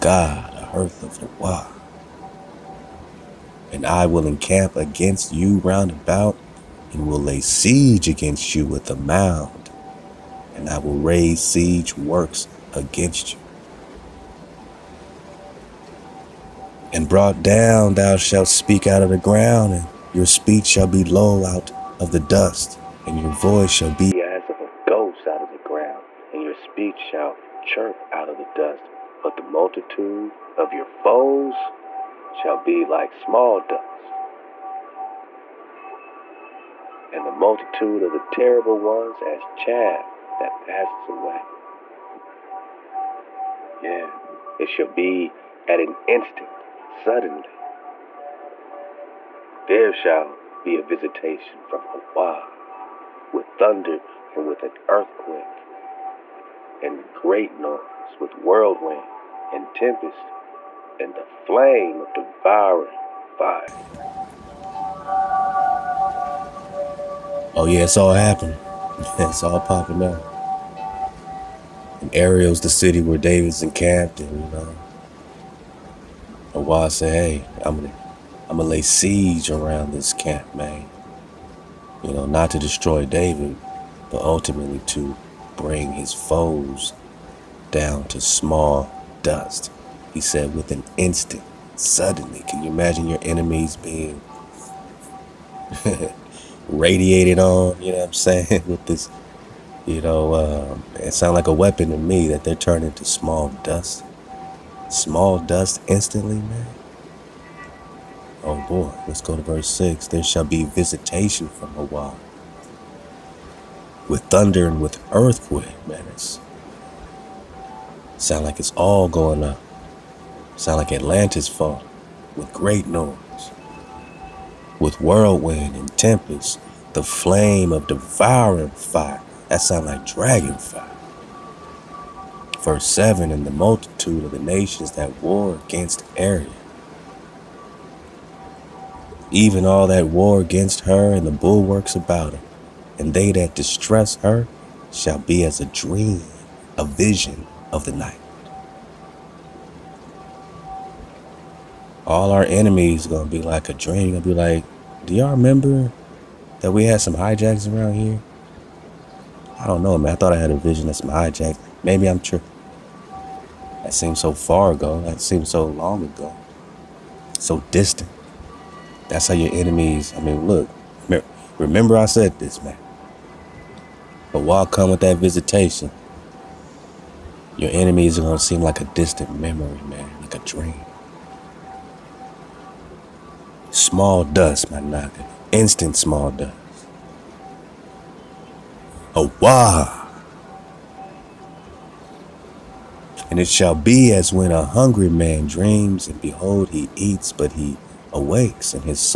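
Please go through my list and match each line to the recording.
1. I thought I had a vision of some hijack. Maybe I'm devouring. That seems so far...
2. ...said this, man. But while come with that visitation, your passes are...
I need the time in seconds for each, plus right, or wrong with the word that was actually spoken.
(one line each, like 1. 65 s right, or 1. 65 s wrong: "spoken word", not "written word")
1. 160 s wrong: "tripping", not "devouring"
2. 172 s wrong: "enemies", not "passes".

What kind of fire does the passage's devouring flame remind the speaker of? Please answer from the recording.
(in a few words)
Dragon fire.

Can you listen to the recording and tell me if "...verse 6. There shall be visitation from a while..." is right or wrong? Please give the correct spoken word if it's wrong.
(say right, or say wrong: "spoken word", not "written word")
right.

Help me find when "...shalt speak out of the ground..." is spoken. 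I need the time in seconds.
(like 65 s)
18 s.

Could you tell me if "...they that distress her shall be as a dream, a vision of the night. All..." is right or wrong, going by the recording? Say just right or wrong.
right.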